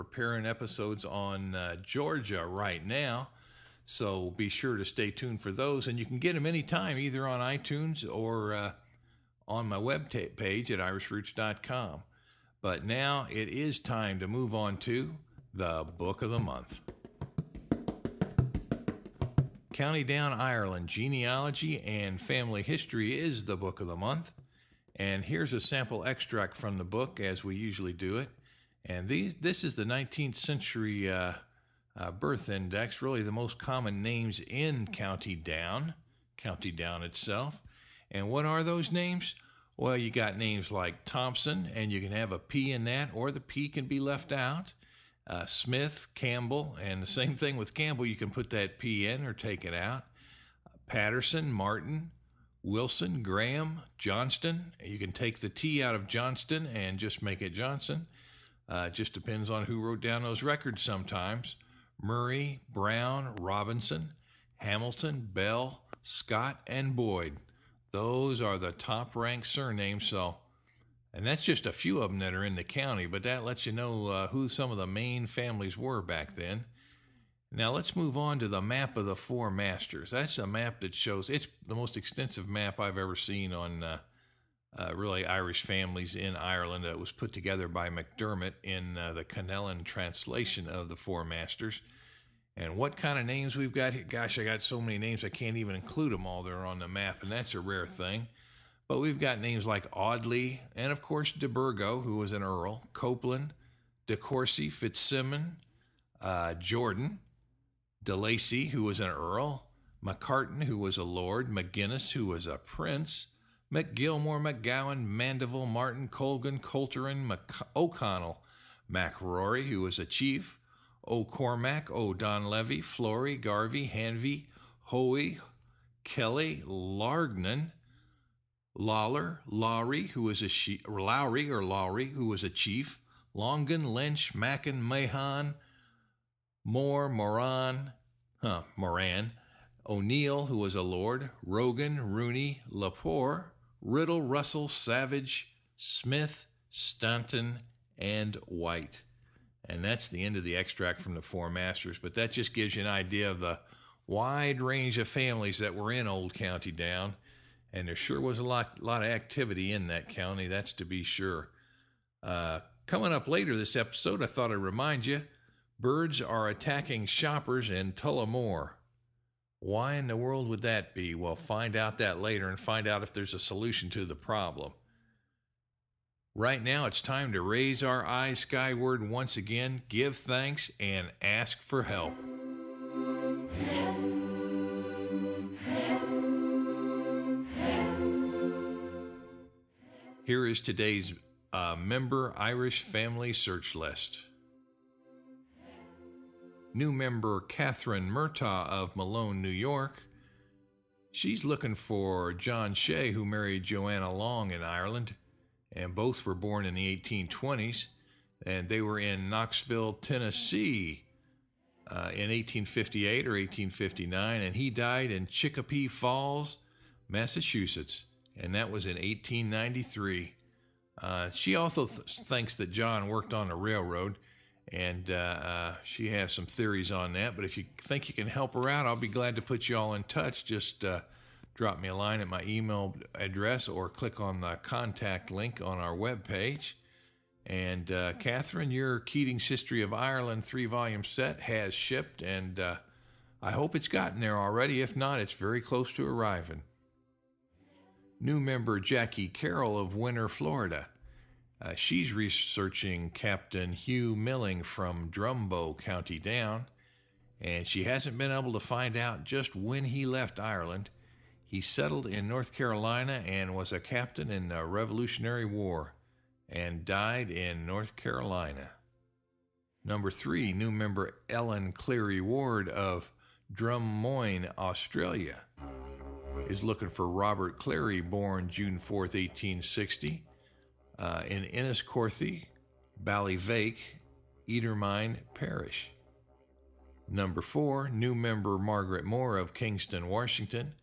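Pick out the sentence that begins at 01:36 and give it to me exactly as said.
They're on the map, and that's a rare thing.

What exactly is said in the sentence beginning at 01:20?
That's a map that shows it's the most extensive map I've ever seen on uh, uh, really Irish families in Ireland.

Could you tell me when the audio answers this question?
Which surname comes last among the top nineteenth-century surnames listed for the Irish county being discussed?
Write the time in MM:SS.
01:06.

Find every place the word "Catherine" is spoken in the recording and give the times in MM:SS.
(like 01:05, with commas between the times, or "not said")
03:17, 03:58.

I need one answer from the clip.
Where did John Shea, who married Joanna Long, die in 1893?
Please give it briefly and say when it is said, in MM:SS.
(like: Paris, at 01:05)
Chicopee Falls, Massachusetts, at 03:35.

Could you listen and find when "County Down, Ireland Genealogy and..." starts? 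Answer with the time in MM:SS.
00:19.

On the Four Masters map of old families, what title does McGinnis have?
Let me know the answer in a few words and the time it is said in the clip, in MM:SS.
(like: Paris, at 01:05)
Prince, at 01:52.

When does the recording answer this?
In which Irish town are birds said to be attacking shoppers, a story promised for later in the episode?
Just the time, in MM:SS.
02:47.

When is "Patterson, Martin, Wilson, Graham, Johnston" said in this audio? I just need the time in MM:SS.
00:50.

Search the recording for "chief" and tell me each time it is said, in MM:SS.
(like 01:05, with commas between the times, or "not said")
02:00, 02:12.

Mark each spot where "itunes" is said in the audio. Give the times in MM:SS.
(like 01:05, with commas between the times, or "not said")
00:07.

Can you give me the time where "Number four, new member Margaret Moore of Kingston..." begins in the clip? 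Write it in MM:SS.
04:47.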